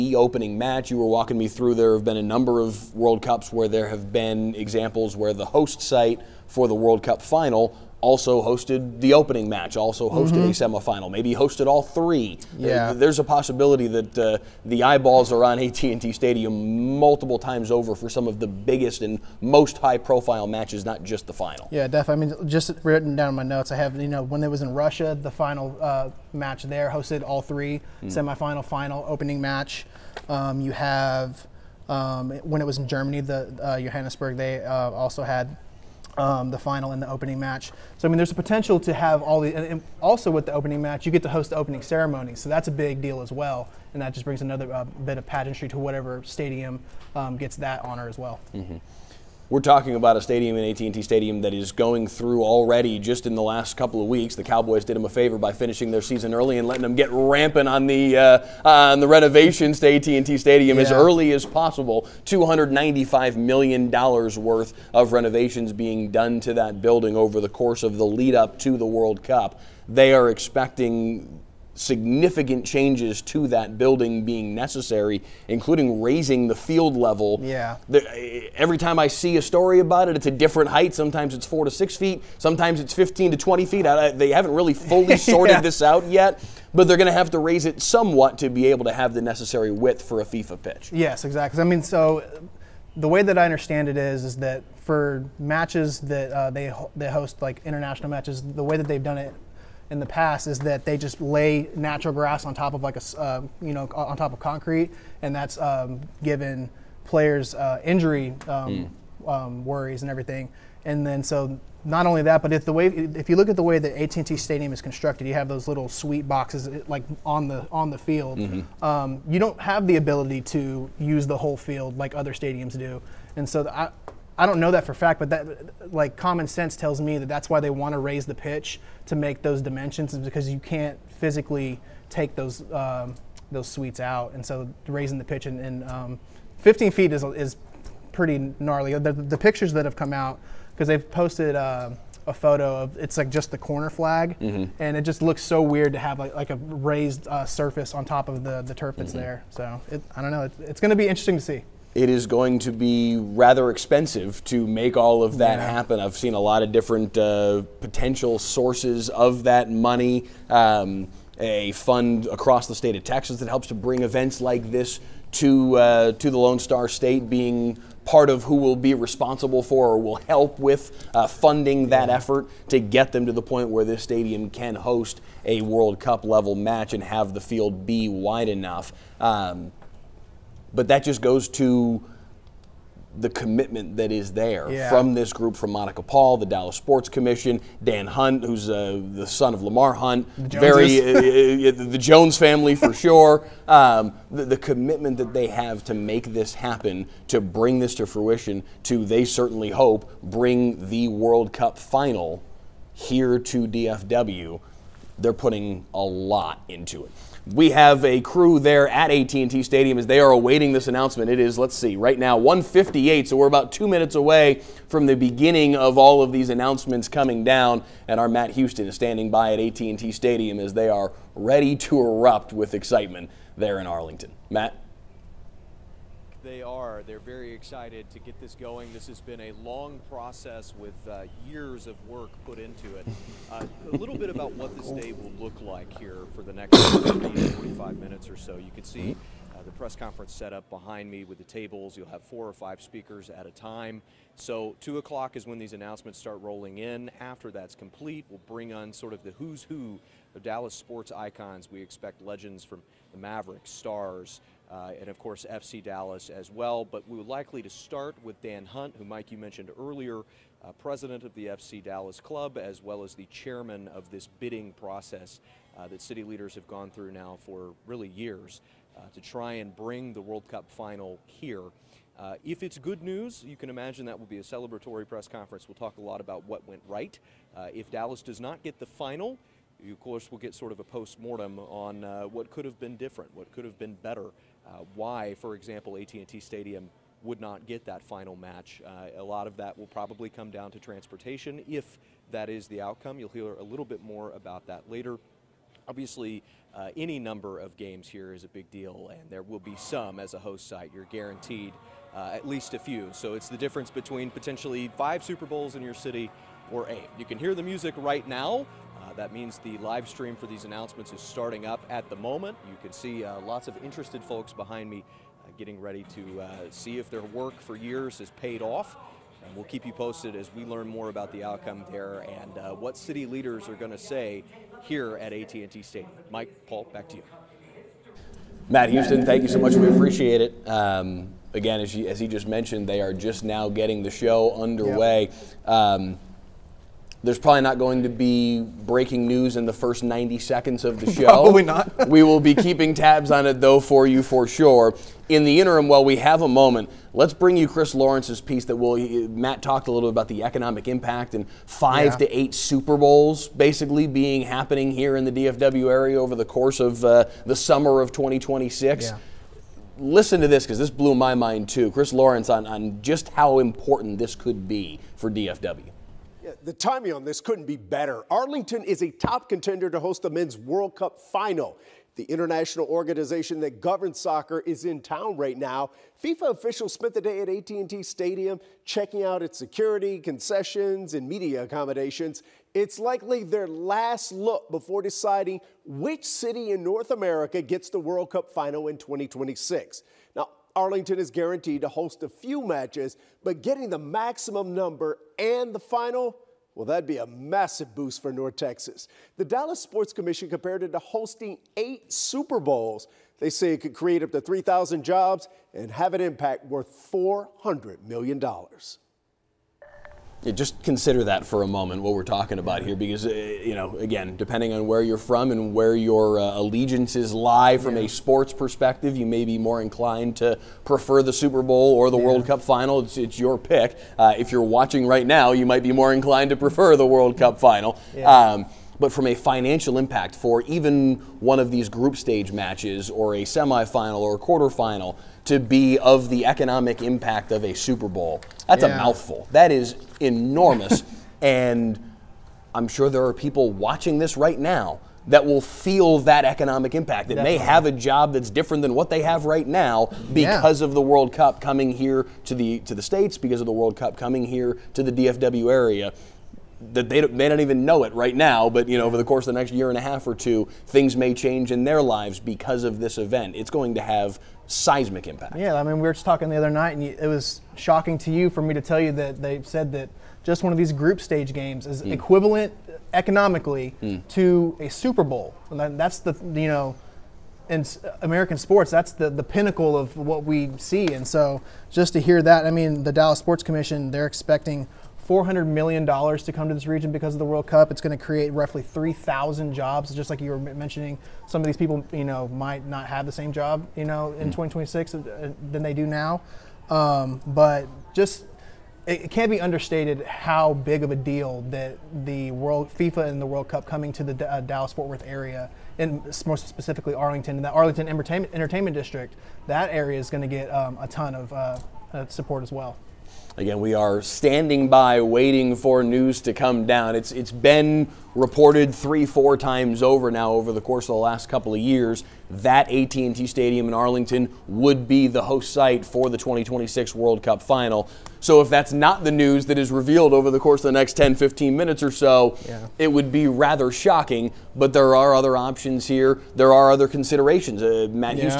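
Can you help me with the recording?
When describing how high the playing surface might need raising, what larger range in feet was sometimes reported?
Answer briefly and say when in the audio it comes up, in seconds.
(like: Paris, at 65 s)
15 to 20 feet, at 82 s.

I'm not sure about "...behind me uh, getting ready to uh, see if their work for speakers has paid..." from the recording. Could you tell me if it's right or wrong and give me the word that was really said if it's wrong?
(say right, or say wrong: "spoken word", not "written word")
wrong: "years", not "speakers".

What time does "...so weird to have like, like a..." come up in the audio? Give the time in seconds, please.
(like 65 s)
145 s.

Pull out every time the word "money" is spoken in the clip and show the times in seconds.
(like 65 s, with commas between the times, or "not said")
159 s.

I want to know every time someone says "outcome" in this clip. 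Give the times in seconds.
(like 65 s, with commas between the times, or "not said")
292 s, 321 s.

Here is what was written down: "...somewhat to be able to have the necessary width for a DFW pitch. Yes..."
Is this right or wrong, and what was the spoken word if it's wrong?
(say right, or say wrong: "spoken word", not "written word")
wrong: "FIFA", not "DFW".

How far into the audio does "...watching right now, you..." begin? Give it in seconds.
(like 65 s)
424 s.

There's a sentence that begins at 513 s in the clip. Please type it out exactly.
Again, we are standing by waiting for news to come down.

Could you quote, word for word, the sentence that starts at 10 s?
a semifinal, maybe hosted all three.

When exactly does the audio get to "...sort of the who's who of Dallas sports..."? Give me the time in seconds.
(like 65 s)
248 s.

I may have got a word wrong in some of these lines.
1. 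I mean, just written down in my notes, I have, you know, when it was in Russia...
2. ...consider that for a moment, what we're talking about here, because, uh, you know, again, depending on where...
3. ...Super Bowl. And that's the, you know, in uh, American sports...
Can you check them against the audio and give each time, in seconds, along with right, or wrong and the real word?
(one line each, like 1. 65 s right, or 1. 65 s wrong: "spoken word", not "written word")
1. 22 s right
2. 410 s right
3. 474 s right.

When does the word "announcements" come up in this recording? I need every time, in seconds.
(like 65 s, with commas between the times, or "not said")
210 s, 216 s, 245 s, 310 s.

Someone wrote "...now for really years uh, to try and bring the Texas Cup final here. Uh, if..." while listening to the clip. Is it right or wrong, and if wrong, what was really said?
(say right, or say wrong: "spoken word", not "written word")
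wrong: "World", not "Texas".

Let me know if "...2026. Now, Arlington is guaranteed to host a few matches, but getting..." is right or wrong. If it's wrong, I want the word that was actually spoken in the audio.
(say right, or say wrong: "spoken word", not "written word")
right.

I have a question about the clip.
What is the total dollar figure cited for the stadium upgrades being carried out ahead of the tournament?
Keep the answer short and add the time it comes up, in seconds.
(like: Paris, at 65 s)
$295 million, at 62 s.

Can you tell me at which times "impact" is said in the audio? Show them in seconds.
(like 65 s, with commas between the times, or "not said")
350 s, 406 s, 429 s, 437 s, 446 s, 465 s.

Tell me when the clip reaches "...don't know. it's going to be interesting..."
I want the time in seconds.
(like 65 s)
150 s.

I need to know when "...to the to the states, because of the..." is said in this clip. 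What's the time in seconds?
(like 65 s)
452 s.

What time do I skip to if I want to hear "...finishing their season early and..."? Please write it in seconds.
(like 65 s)
55 s.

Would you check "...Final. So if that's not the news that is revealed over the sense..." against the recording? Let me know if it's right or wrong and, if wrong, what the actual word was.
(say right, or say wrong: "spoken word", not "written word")
wrong: "course", not "sense".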